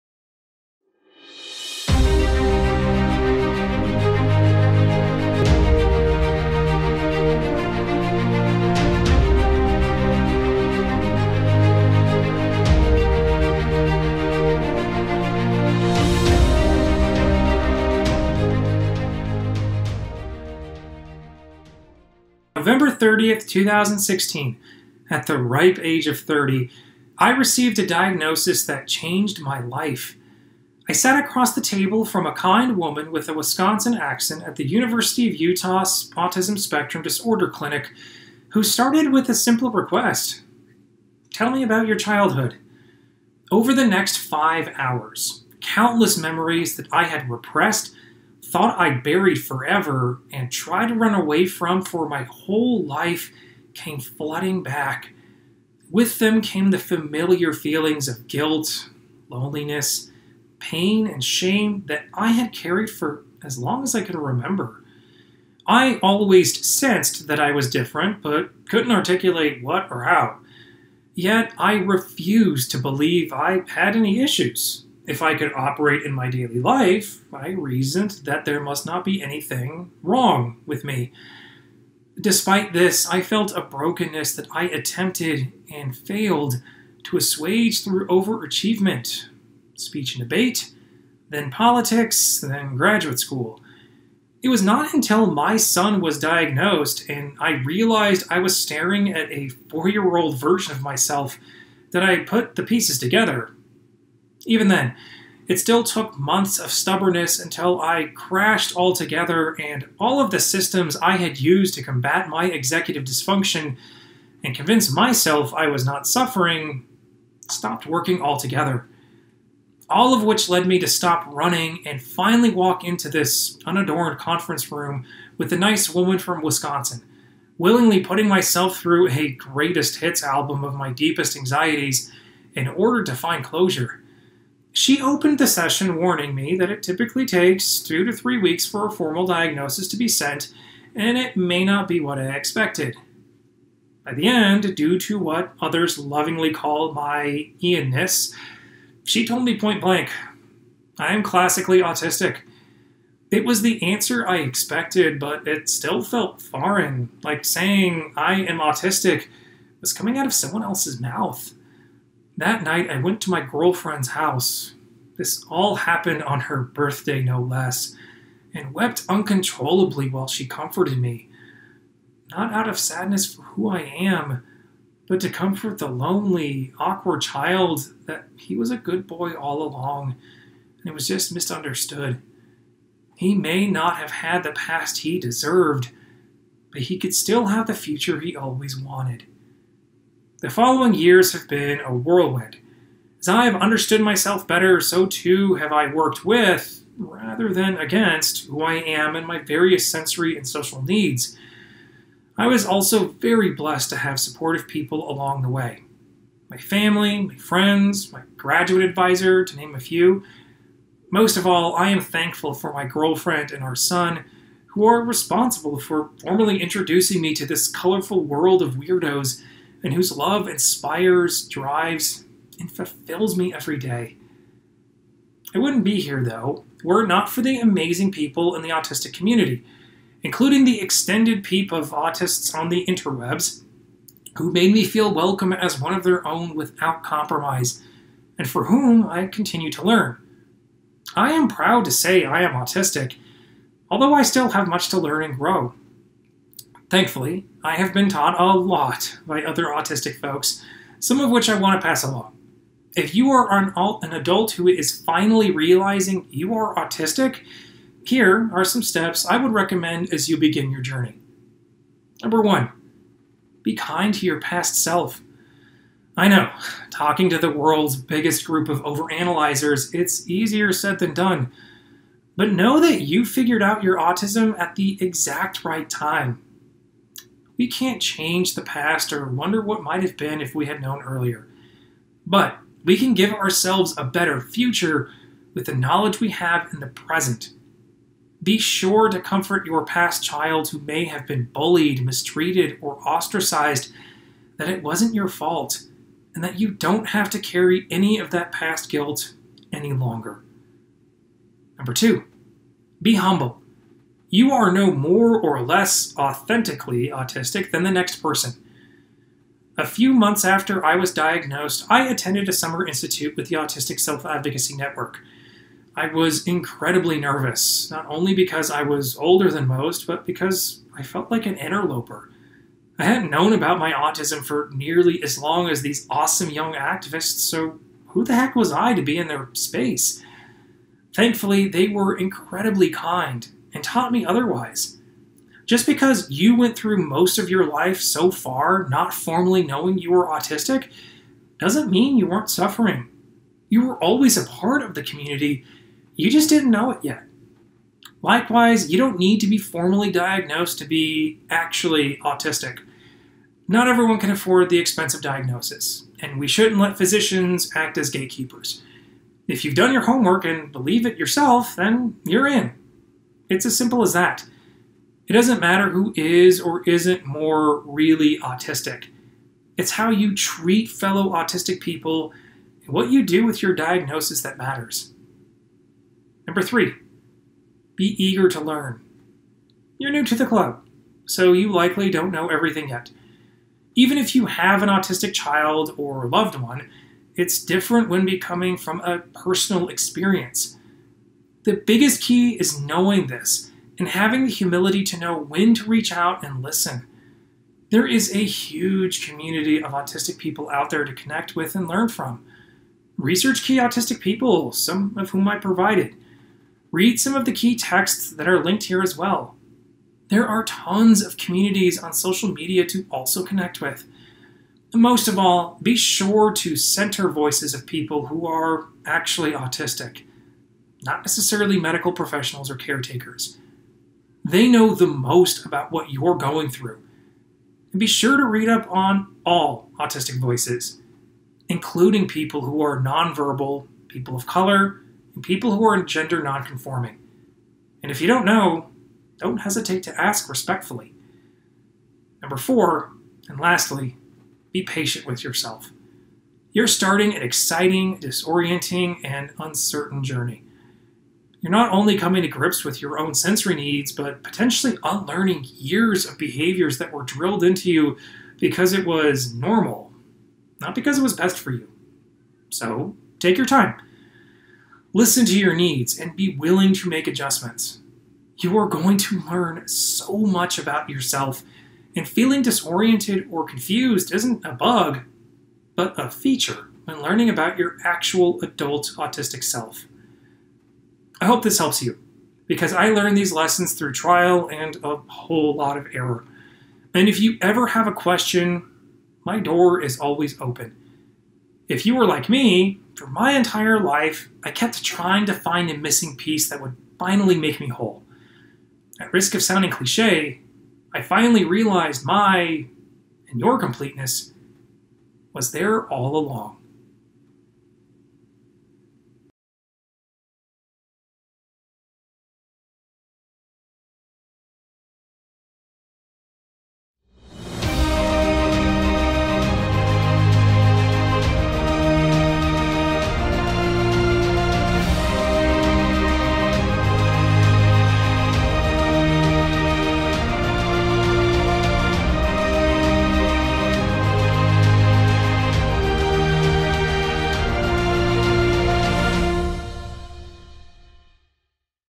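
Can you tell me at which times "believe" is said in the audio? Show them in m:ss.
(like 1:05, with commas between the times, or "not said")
1:12, 6:00.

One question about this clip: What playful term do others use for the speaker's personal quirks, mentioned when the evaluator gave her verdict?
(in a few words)
Ianness.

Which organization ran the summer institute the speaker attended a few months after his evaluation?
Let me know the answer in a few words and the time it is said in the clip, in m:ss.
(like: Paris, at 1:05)
Autistic Self Advocacy Network, at 5:13.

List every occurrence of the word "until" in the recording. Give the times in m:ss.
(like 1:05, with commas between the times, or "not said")
1:34, 1:47.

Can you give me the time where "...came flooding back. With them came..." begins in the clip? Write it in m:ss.
0:53.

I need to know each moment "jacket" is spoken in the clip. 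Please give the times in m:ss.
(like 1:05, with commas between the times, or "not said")
not said.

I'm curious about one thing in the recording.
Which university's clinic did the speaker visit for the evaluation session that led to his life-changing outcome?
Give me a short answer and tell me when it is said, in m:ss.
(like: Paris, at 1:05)
University of Utah, at 0:34.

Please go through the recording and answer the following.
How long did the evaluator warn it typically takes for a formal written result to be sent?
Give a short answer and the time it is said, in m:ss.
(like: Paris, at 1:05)
2 to 3 weeks, at 2:17.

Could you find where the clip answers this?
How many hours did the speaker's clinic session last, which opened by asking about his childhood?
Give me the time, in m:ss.
0:44.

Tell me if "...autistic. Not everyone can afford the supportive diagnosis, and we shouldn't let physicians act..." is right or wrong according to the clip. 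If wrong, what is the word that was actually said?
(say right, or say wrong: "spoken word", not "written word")
wrong: "expensive", not "supportive".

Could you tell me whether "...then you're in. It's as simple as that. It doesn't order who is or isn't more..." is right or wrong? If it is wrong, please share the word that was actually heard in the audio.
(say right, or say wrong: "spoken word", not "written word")
wrong: "matter", not "order".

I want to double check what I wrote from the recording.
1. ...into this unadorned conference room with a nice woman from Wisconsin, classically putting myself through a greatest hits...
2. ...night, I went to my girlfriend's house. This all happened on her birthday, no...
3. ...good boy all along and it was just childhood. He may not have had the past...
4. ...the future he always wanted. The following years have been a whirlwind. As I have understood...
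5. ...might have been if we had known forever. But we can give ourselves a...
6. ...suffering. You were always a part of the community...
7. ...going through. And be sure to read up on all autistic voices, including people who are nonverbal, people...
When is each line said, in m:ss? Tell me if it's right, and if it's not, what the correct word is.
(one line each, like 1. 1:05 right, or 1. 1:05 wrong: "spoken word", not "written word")
1. 2:02 wrong: "willingly", not "classically"
2. 2:42 right
3. 2:58 wrong: "misunderstood", not "childhood"
4. 3:07 right
5. 4:39 wrong: "earlier", not "forever"
6. 5:42 right
7. 7:06 right.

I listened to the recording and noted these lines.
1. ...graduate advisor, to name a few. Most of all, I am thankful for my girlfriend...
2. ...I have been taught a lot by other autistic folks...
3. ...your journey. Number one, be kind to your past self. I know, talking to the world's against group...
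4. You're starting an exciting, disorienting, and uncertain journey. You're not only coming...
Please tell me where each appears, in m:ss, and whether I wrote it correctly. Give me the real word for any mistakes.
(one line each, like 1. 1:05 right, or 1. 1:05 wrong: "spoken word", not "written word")
1. 3:28 right
2. 4:07 right
3. 4:20 wrong: "biggest", not "against"
4. 7:26 right.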